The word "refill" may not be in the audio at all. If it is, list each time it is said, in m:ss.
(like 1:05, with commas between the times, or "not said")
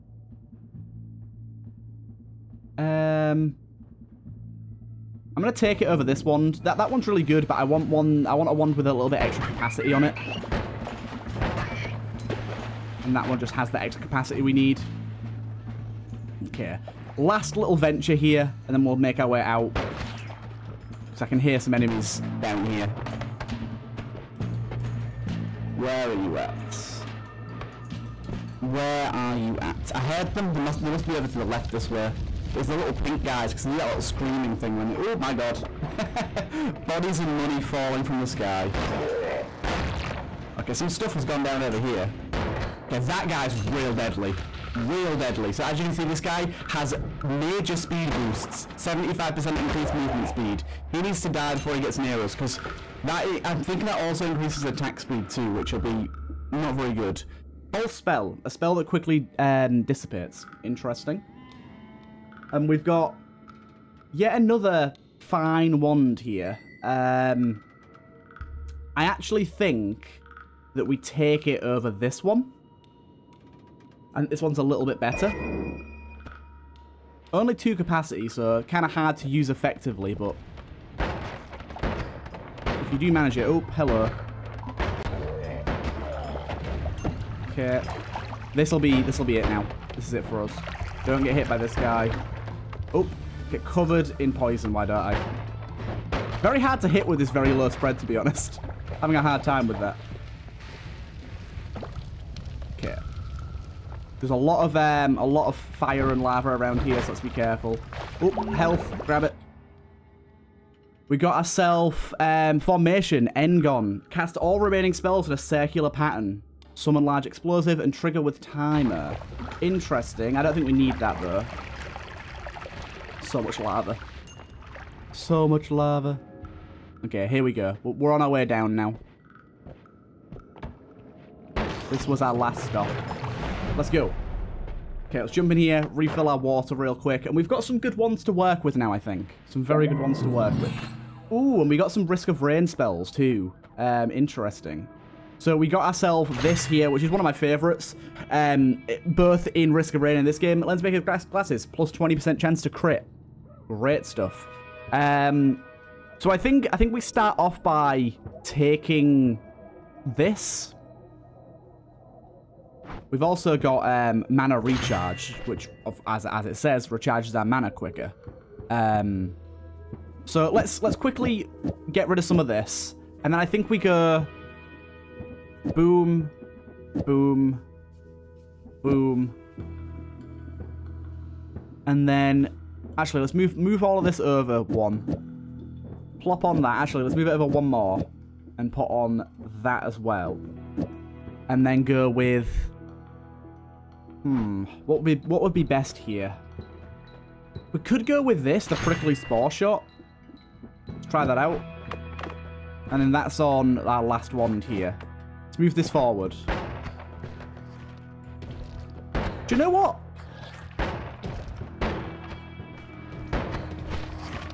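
2:15.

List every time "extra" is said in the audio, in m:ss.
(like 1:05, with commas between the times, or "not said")
0:09, 0:13.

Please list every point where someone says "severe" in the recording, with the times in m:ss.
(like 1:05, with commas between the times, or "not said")
not said.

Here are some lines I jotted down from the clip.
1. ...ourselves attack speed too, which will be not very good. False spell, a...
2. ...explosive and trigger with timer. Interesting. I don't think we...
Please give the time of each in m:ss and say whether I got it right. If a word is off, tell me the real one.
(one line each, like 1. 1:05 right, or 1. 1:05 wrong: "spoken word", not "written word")
1. 0:54 wrong: "increases", not "ourselves"
2. 1:57 right.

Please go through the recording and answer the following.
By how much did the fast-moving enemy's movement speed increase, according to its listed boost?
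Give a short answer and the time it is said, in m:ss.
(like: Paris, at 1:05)
75%, at 0:48.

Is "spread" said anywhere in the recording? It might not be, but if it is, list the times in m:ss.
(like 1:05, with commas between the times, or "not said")
1:37.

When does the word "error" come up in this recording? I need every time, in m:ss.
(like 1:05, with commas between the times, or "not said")
not said.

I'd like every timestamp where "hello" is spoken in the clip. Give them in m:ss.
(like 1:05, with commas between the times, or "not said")
1:23.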